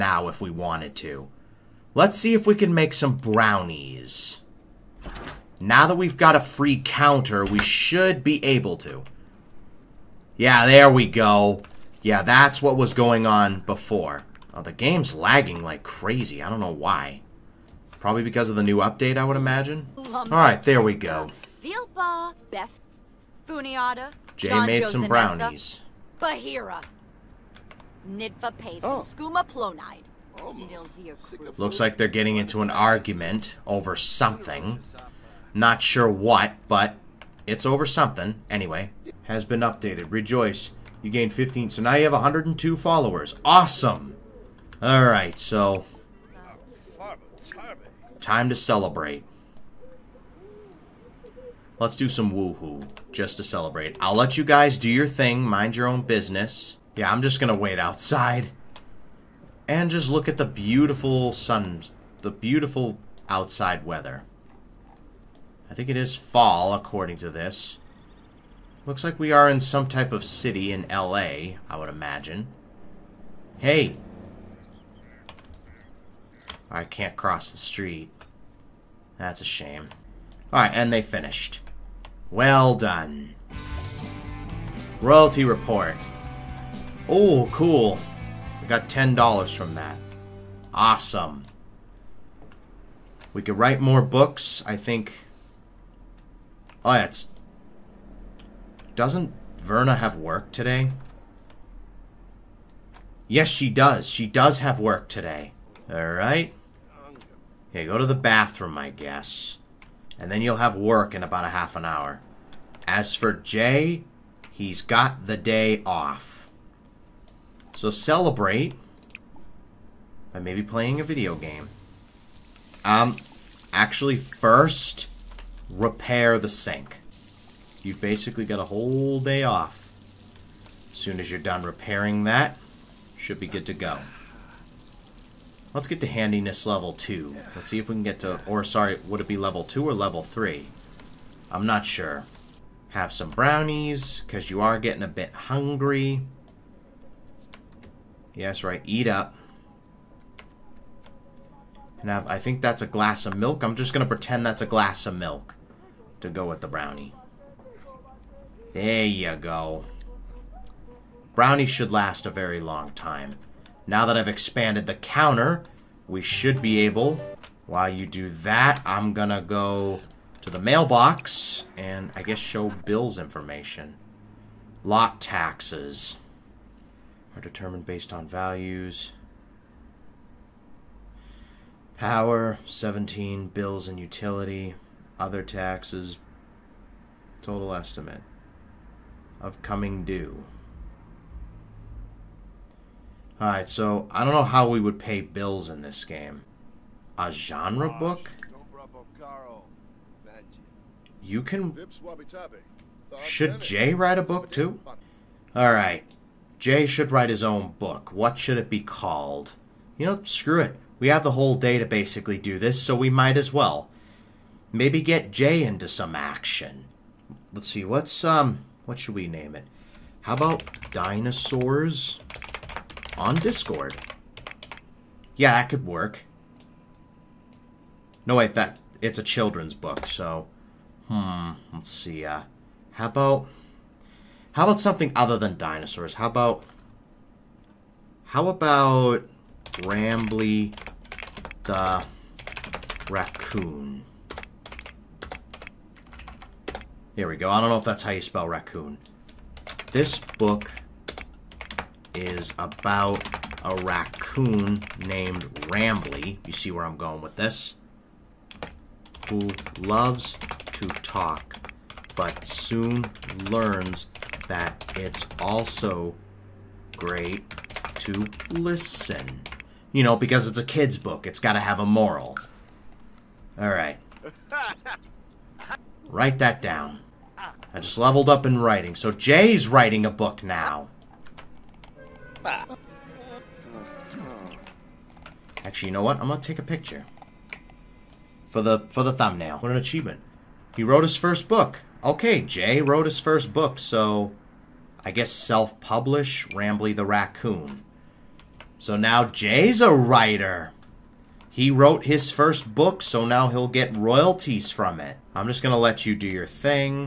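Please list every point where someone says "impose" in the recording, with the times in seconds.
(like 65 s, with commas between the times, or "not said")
not said.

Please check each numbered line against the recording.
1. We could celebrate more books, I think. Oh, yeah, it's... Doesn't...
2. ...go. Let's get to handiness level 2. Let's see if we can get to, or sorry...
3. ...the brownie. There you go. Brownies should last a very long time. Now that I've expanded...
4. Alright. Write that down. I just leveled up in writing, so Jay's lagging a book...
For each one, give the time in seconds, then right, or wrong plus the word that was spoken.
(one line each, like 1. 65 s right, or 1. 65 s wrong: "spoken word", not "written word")
1. 93 s wrong: "write", not "celebrate"
2. 133 s right
3. 156 s right
4. 273 s wrong: "writing", not "lagging".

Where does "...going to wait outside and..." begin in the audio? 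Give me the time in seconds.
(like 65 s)
57 s.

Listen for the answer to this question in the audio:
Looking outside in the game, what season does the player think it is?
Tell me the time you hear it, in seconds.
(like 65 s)
66 s.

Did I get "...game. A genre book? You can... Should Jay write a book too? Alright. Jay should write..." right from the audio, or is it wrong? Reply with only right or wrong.
right.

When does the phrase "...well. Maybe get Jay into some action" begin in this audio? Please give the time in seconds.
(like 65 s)
213 s.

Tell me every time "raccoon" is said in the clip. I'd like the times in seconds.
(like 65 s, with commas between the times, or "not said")
243 s, 248 s, 253 s, 297 s.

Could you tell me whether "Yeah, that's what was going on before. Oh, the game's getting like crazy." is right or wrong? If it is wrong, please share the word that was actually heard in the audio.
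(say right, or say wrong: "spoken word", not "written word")
wrong: "lagging", not "getting".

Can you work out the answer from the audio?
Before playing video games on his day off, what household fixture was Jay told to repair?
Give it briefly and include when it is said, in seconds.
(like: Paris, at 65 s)
The sink, at 126 s.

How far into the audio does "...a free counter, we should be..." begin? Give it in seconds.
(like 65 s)
6 s.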